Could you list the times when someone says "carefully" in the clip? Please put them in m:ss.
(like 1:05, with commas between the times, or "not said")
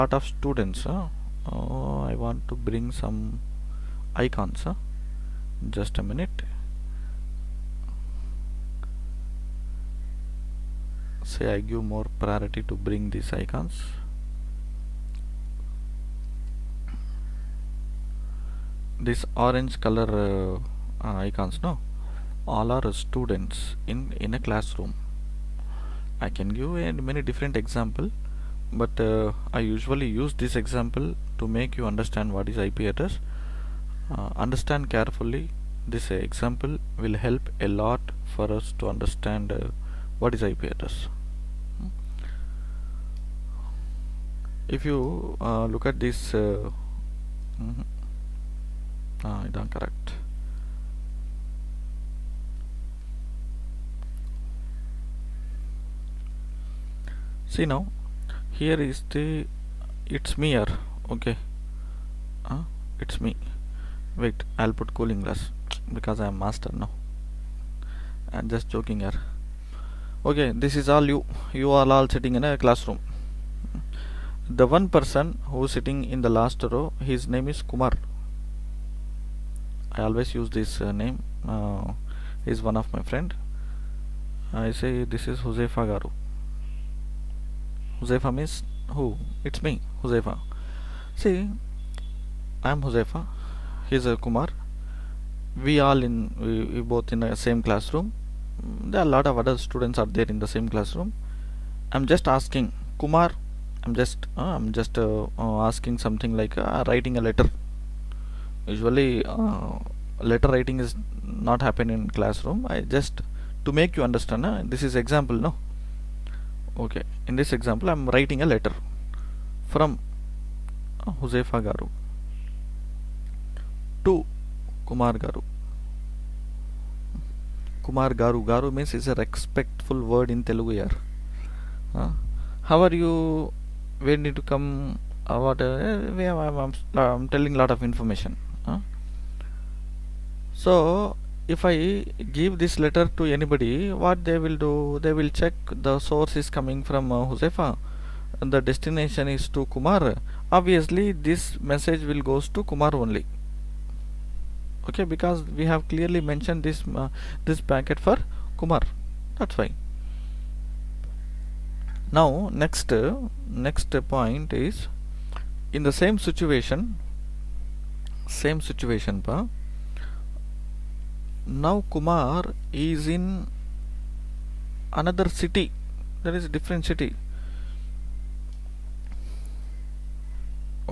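0:34.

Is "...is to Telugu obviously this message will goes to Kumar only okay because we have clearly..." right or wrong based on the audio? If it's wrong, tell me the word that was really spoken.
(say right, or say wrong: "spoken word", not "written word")
wrong: "Kumar", not "Telugu".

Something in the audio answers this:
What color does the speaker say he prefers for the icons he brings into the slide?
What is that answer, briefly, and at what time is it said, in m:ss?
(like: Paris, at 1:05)
Orange, at 0:19.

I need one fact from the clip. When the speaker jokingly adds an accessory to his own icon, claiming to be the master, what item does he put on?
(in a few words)
Cooling glass.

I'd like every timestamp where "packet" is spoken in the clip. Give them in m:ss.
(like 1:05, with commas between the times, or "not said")
2:37.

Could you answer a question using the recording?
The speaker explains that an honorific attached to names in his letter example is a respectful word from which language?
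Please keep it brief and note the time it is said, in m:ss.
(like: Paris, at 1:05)
Telugu, at 2:10.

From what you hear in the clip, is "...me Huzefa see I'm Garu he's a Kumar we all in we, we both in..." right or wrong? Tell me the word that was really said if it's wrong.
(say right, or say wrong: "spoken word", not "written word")
wrong: "Huzefa", not "Garu".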